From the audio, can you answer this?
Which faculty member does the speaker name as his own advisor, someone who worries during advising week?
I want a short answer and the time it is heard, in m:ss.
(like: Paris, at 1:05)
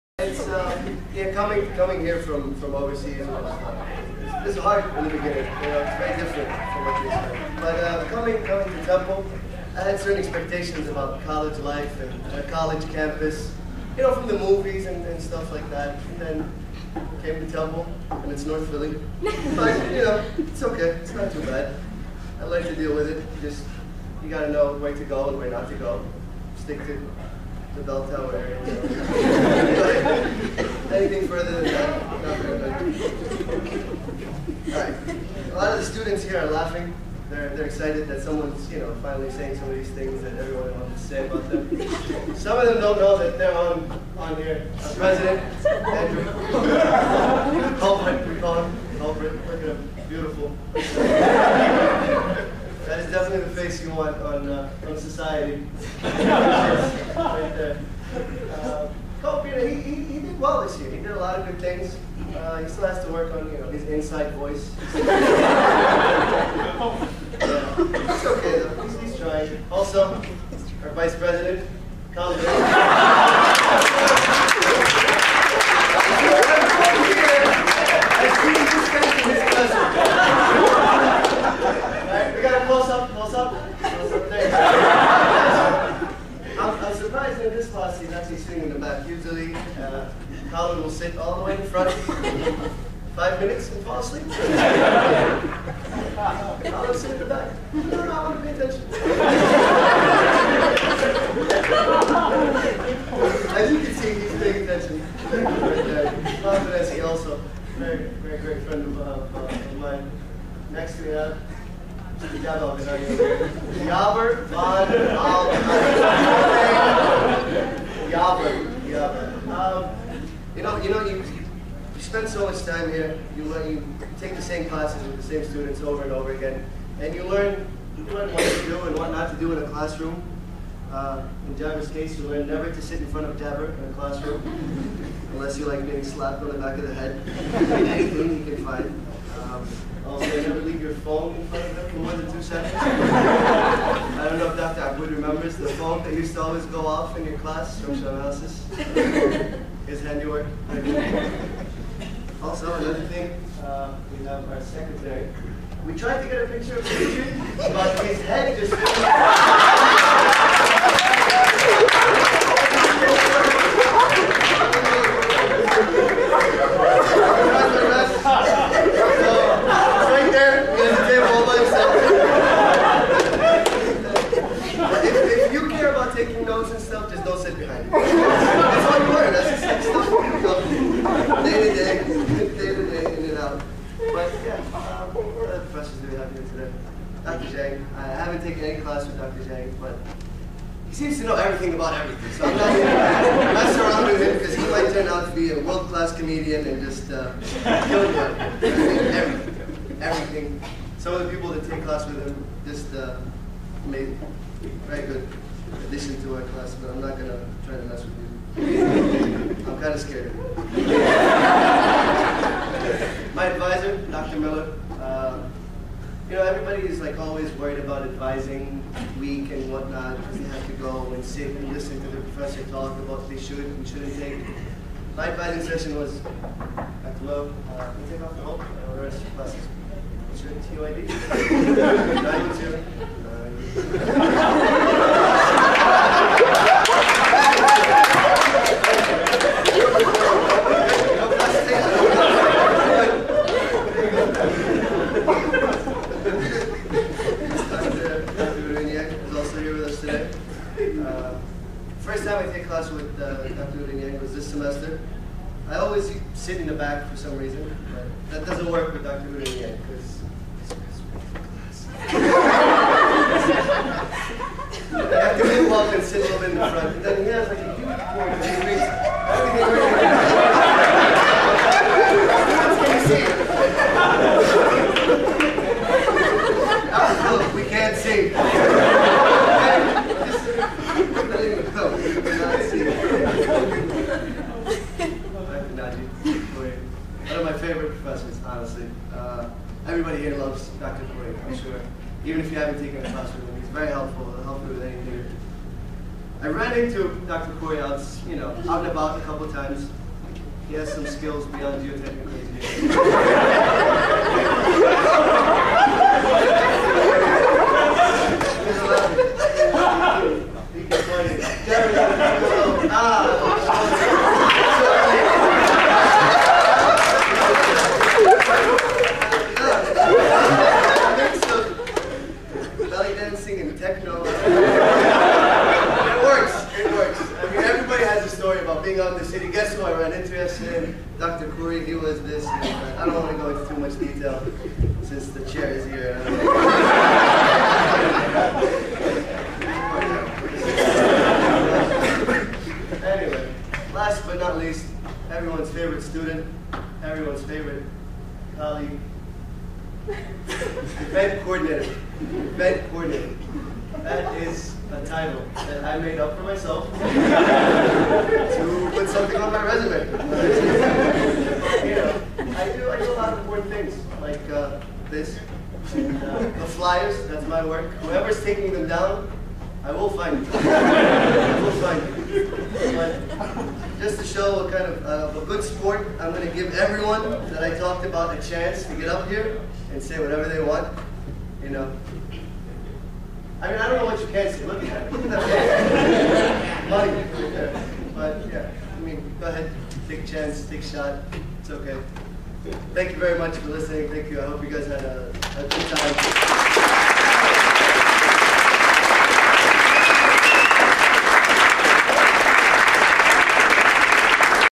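Dr. Miller, at 3:34.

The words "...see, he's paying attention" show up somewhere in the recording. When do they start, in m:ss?
1:43.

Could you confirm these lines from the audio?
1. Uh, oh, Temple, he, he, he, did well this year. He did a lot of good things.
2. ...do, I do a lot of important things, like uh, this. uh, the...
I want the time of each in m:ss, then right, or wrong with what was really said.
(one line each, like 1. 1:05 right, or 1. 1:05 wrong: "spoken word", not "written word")
1. 0:58 wrong: "Peter", not "Temple"
2. 6:02 right.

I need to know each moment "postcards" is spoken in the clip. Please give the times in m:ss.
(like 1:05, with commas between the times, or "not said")
not said.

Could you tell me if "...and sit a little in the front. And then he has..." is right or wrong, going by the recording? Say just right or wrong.
right.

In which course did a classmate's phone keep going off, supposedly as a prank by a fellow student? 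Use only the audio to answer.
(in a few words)
Structural analysis.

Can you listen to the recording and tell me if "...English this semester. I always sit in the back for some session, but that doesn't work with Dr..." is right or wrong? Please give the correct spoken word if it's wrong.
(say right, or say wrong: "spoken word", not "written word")
wrong: "reason", not "session".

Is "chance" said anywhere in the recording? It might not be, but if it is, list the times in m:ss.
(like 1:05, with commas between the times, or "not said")
6:18, 6:30.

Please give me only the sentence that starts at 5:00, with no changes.
He has some skills beyond geotechnical engineering.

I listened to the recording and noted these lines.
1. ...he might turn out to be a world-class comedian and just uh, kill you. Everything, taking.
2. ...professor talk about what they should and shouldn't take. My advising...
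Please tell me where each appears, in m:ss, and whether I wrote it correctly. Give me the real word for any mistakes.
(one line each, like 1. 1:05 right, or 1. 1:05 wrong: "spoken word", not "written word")
1. 3:14 wrong: "everything", not "taking"
2. 3:42 right.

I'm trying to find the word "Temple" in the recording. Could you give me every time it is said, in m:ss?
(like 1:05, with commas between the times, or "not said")
0:08, 0:17.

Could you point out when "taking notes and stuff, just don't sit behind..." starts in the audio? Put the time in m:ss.
2:56.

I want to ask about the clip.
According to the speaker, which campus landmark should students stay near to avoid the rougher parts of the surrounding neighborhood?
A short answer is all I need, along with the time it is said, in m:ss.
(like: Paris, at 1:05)
The bell tower, at 0:27.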